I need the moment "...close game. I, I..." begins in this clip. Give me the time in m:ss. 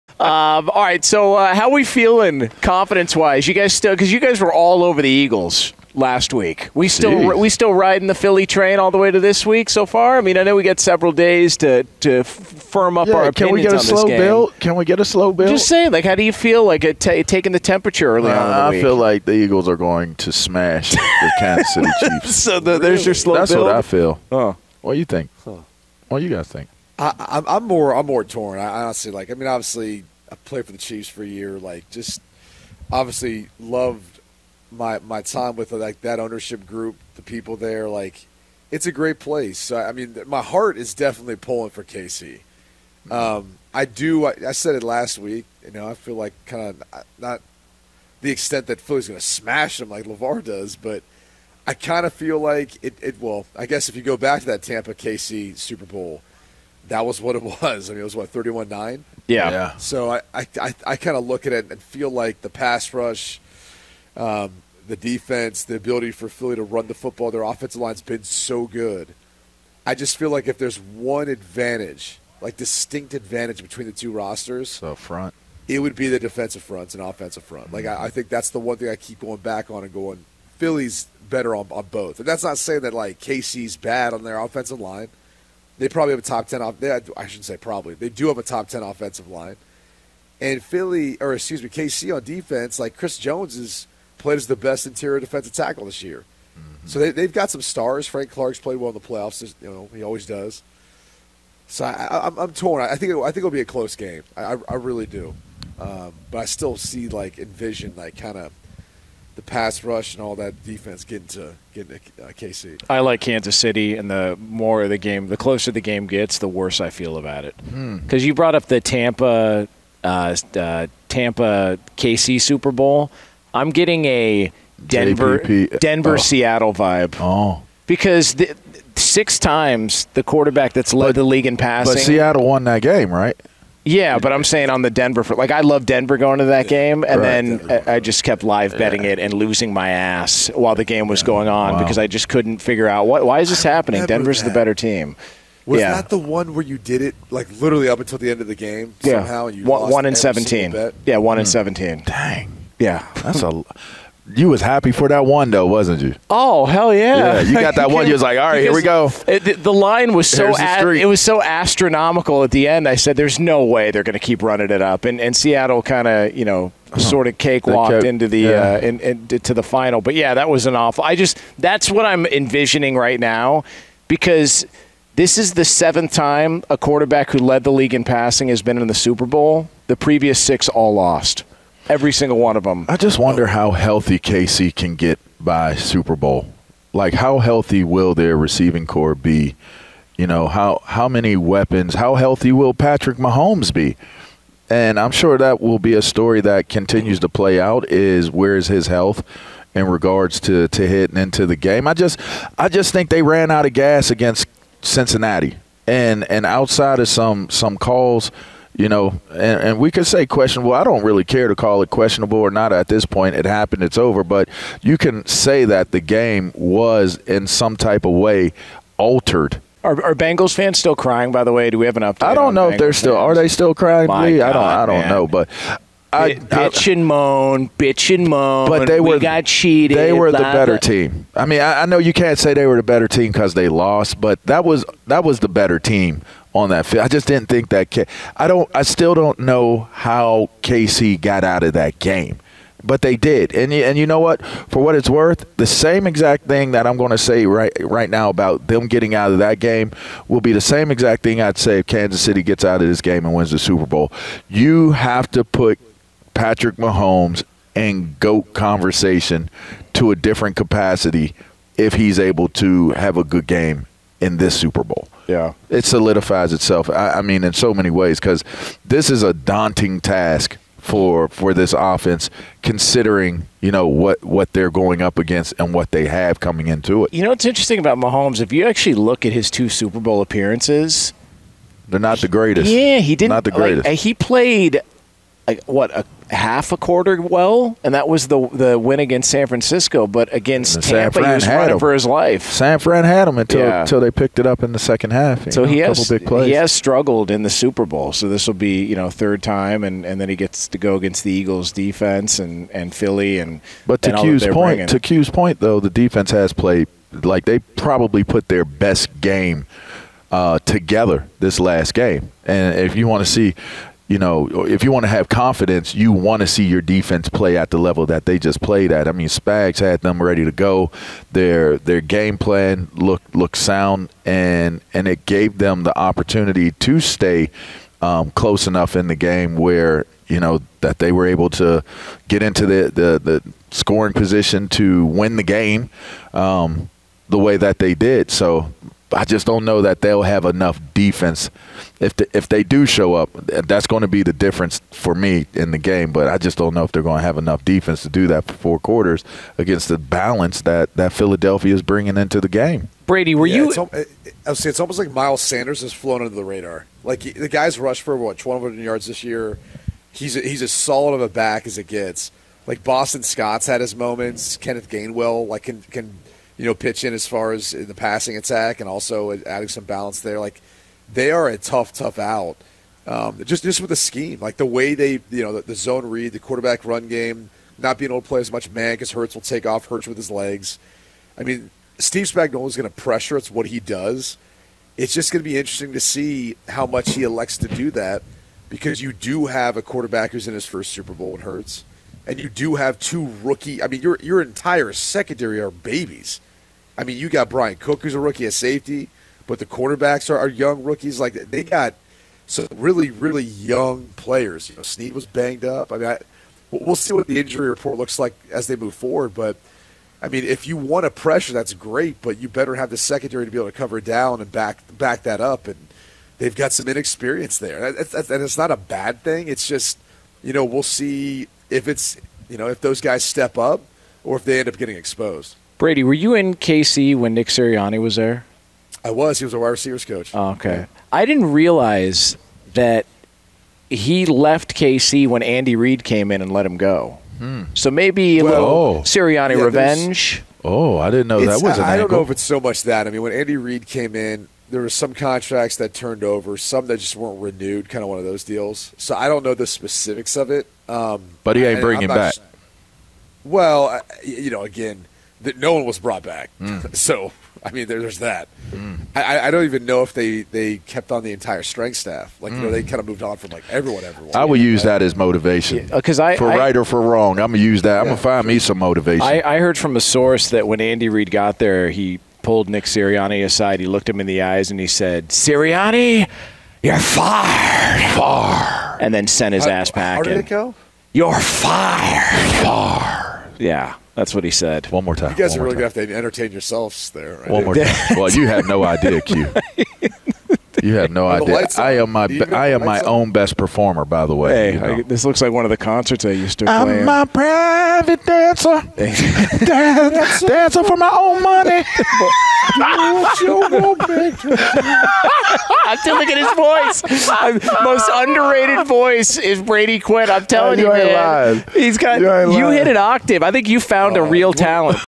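1:43.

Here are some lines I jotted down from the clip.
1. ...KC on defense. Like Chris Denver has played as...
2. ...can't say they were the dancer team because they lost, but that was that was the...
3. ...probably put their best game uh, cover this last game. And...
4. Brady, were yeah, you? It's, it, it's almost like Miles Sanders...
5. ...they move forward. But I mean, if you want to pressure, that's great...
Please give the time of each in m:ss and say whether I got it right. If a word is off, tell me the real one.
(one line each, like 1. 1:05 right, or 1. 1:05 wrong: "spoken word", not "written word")
1. 1:31 wrong: "Jones", not "Denver"
2. 3:52 wrong: "better", not "dancer"
3. 5:07 wrong: "together", not "cover"
4. 5:53 right
5. 6:48 right.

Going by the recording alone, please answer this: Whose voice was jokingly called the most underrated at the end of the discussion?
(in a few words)
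Brady Quinn.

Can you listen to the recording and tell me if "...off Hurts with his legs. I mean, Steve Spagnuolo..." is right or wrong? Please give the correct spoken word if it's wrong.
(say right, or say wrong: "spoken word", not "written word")
right.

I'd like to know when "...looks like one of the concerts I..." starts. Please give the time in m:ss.
8:15.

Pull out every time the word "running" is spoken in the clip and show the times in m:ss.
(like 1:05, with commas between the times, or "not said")
2:44, 4:51.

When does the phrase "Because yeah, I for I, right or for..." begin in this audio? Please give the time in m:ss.
7:45.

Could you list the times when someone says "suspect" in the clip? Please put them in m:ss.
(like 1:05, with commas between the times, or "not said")
not said.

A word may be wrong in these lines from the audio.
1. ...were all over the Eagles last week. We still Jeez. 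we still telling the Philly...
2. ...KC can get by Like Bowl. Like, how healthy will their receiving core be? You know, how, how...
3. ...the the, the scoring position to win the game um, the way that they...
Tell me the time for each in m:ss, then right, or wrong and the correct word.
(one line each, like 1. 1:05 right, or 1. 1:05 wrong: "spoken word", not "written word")
1. 0:04 wrong: "riding", not "telling"
2. 3:04 wrong: "Super", not "Like"
3. 5:32 right.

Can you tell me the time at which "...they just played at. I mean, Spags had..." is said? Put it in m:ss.
5:18.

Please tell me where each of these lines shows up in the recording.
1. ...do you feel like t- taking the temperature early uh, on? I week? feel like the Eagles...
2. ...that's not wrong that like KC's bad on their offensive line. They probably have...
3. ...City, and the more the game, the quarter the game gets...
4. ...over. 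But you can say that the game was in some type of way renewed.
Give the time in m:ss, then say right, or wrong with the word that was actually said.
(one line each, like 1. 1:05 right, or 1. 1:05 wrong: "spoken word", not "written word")
1. 0:16 right
2. 1:22 wrong: "saying", not "wrong"
3. 1:53 wrong: "closer", not "quarter"
4. 3:33 wrong: "altered", not "renewed".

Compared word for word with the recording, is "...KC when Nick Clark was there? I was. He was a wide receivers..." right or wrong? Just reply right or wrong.
wrong.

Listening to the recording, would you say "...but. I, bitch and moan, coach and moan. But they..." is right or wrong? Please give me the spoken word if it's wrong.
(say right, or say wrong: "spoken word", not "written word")
wrong: "bitch", not "coach".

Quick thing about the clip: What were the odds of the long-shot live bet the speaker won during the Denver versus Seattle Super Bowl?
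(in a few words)
1 in 17.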